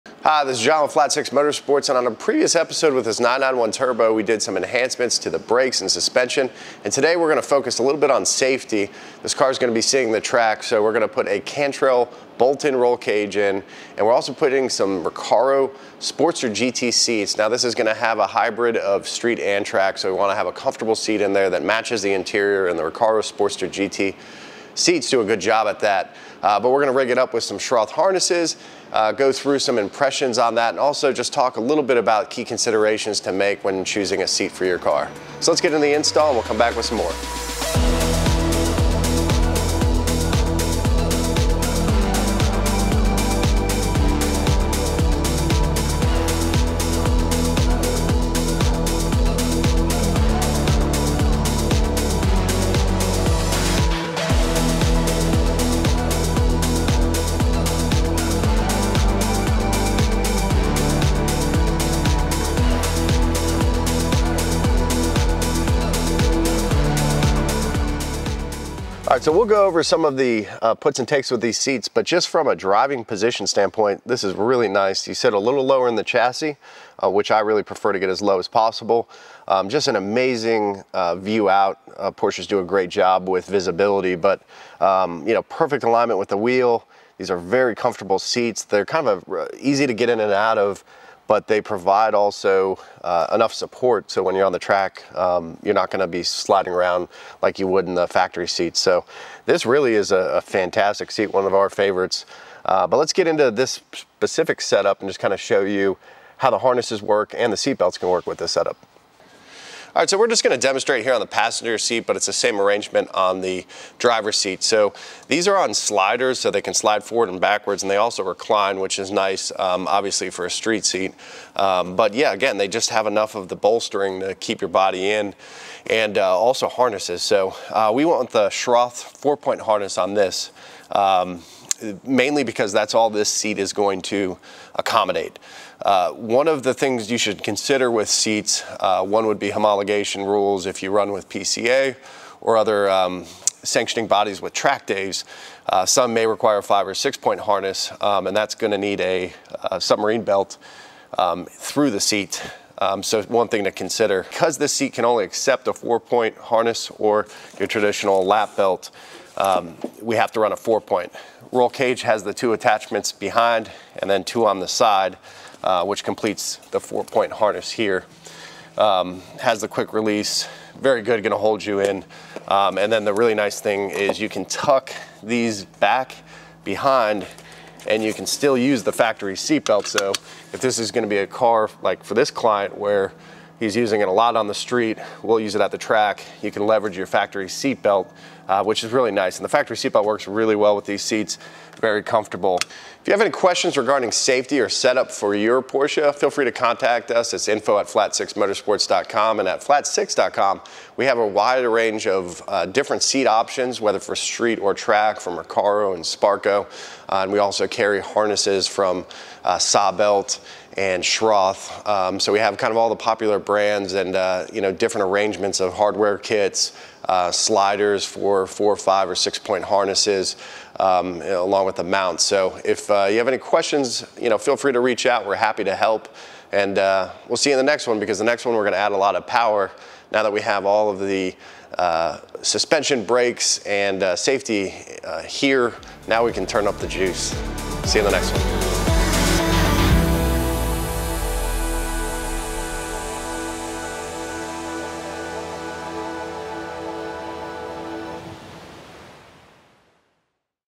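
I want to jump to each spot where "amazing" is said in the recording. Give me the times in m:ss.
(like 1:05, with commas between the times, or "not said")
1:19.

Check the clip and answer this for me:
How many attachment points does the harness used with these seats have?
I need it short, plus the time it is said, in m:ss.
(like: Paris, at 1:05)
4, at 2:09.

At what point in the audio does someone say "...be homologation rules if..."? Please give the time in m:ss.
2:19.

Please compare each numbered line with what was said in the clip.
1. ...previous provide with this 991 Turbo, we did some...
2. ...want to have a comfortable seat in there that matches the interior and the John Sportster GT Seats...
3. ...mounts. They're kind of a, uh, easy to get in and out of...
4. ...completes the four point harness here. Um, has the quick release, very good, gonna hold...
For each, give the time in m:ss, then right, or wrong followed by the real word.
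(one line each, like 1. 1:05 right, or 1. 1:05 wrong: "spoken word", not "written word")
1. 0:02 wrong: "episode", not "provide"
2. 0:20 wrong: "Recaro", not "John"
3. 1:28 wrong: "seats", not "mounts"
4. 2:46 right.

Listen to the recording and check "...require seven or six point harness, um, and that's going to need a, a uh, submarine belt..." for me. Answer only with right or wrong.
wrong.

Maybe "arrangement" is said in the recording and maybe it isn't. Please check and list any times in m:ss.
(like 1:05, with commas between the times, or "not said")
1:52, 3:35.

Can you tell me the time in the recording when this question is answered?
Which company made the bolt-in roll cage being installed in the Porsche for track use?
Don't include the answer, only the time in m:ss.
0:11.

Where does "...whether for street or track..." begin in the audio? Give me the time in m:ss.
3:23.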